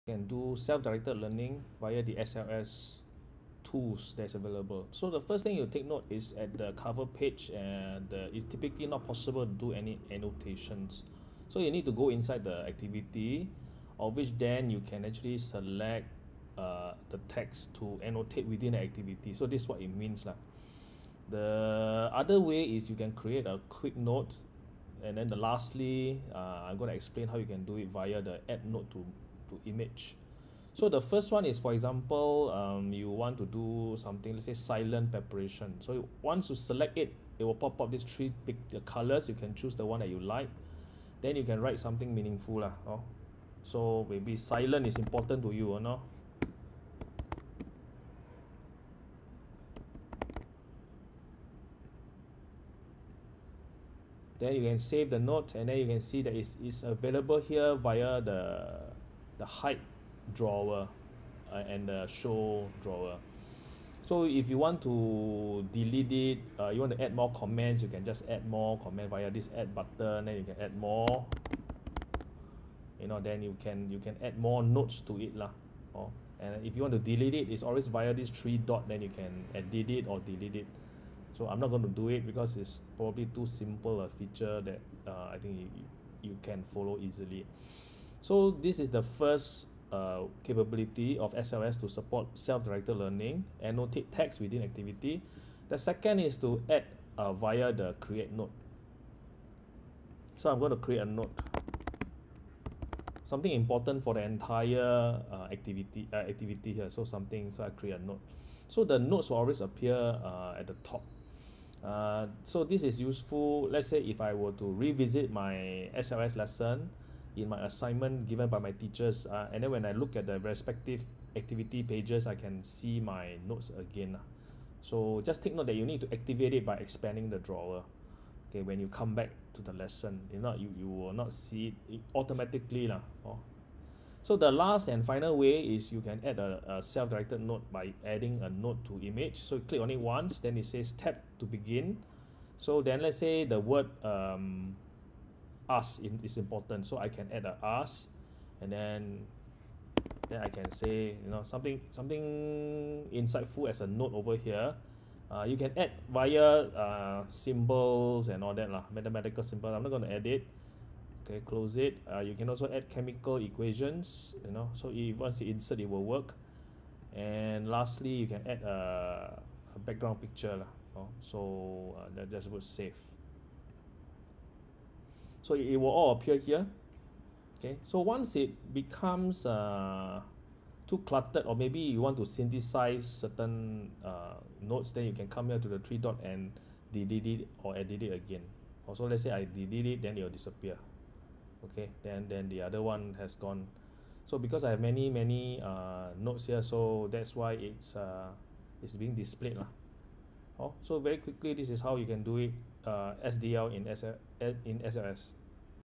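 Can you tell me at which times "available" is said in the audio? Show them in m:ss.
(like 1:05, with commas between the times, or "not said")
0:04, 0:56.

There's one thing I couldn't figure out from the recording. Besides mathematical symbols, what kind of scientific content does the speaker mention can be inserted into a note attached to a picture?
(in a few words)
chemical equations.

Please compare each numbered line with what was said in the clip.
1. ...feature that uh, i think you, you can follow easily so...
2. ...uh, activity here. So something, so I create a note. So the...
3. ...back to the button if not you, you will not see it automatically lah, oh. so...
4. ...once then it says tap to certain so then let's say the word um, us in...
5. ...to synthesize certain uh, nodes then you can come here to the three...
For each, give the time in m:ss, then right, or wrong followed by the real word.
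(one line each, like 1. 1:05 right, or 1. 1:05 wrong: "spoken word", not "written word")
1. 1:24 right
2. 1:46 right
3. 2:09 wrong: "lesson", not "button"
4. 2:19 wrong: "begin", not "certain"
5. 3:02 right.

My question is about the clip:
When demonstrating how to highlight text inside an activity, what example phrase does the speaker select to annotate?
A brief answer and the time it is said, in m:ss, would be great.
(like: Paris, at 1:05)
silent preparation, at 0:34.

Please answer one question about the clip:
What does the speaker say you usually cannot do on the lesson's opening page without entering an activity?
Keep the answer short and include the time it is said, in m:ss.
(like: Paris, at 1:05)
annotations, at 0:10.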